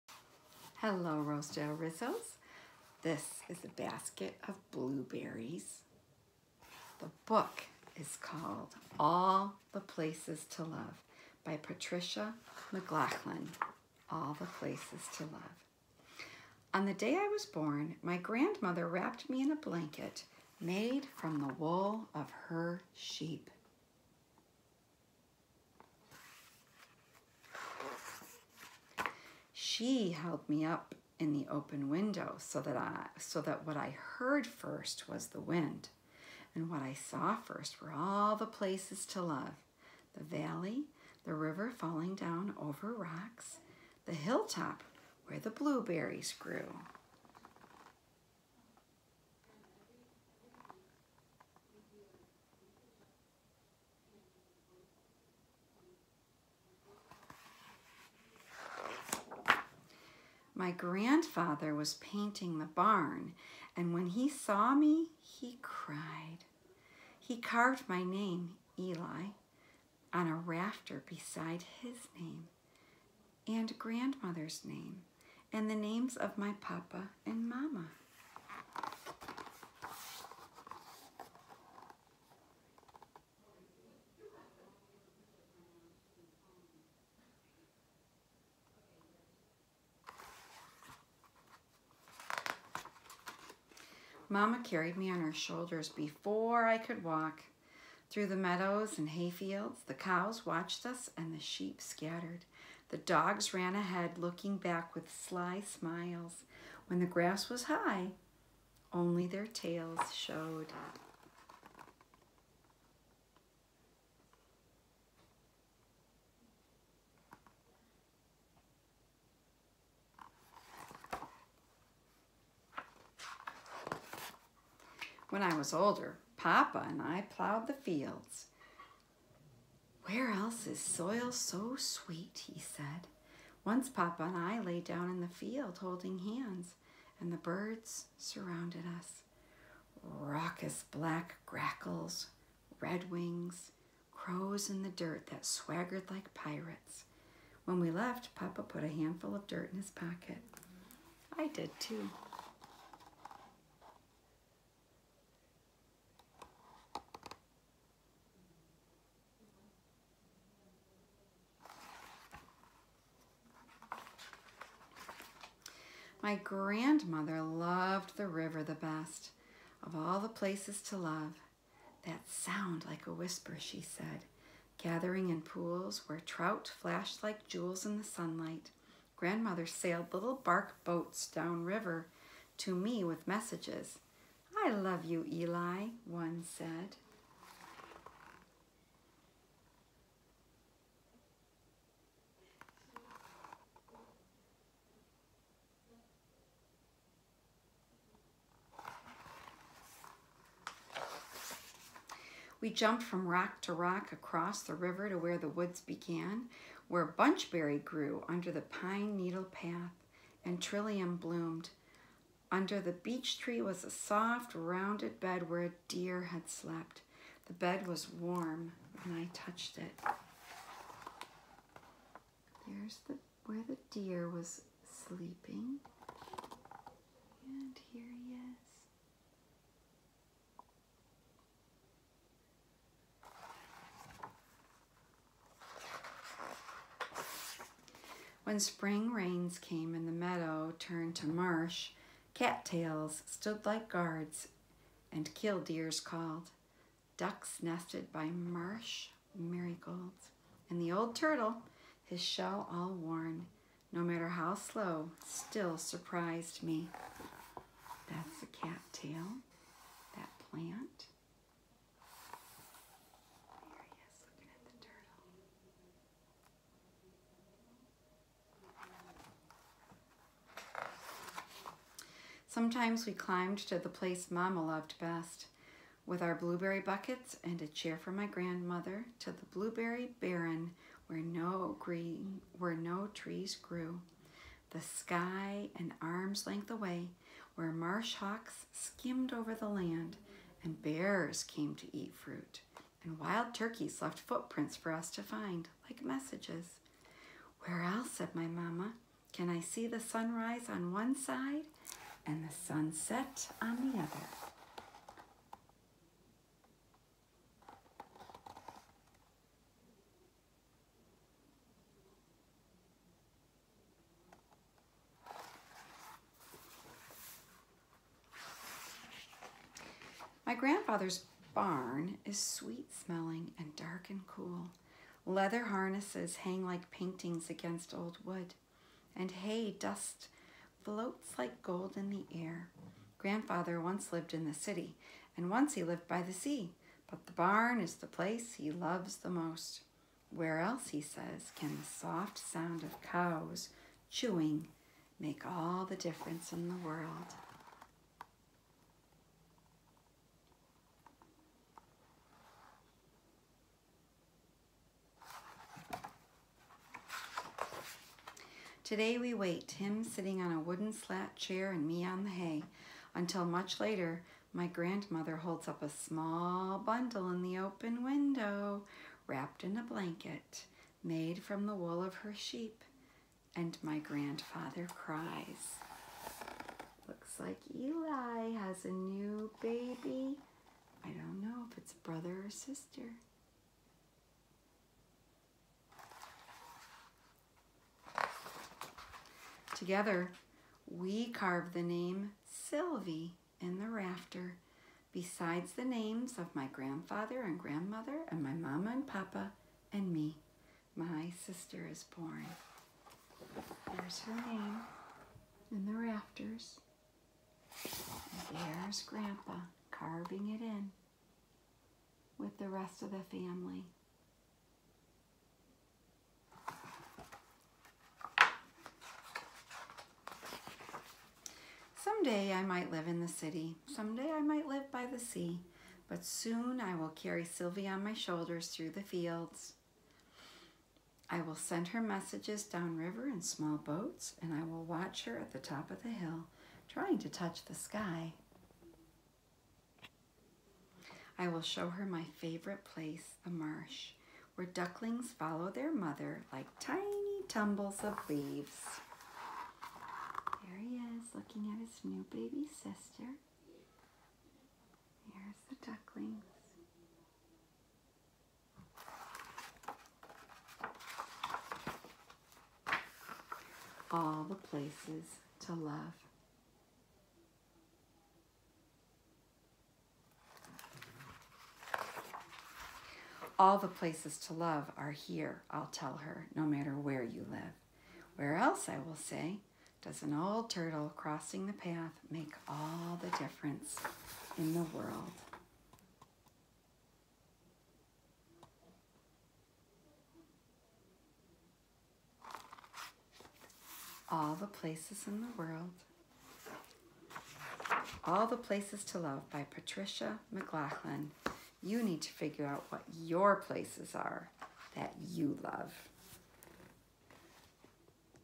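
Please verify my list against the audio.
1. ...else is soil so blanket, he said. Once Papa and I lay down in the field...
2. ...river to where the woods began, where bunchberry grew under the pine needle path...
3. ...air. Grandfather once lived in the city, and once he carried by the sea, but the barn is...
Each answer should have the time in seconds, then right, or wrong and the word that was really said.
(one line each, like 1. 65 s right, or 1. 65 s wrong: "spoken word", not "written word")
1. 130 s wrong: "sweet", not "blanket"
2. 204 s right
3. 332 s wrong: "lived", not "carried".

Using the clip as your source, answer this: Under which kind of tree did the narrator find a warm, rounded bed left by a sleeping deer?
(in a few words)
beech tree.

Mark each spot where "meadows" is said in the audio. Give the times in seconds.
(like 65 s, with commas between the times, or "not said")
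98 s, 240 s.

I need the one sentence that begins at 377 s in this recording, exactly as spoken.
Looks like Eli has a new baby.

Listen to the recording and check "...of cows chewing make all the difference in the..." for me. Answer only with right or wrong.
right.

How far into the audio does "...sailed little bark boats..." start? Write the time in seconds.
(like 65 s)
179 s.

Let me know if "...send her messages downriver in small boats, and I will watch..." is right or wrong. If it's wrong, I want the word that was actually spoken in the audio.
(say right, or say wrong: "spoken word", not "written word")
right.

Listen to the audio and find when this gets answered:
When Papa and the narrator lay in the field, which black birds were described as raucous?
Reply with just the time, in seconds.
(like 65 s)
141 s.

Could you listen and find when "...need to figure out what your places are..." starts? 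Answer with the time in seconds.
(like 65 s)
502 s.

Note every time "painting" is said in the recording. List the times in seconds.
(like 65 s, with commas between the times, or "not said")
61 s, 326 s.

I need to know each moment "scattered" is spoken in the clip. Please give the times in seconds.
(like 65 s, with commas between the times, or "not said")
101 s.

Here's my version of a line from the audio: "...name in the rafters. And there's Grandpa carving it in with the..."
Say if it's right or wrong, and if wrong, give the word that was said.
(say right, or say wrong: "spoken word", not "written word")
right.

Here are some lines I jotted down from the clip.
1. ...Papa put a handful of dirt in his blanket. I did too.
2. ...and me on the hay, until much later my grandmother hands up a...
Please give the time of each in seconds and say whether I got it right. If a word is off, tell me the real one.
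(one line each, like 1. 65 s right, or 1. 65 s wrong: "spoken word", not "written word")
1. 148 s wrong: "pocket", not "blanket"
2. 361 s wrong: "holds", not "hands".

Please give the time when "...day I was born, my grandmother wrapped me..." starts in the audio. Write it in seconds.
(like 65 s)
16 s.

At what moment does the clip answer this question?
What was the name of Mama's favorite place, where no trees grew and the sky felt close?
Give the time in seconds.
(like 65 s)
279 s.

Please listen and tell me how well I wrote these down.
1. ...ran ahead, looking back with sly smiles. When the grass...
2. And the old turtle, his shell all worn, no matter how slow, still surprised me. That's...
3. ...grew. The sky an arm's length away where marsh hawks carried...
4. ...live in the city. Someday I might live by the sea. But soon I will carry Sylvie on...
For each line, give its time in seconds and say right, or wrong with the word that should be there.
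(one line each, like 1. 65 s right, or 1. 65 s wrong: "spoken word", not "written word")
1. 103 s right
2. 250 s right
3. 283 s wrong: "skimmed", not "carried"
4. 422 s right.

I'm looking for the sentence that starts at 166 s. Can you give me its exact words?
My grandmother loved the river the best of all the places to love.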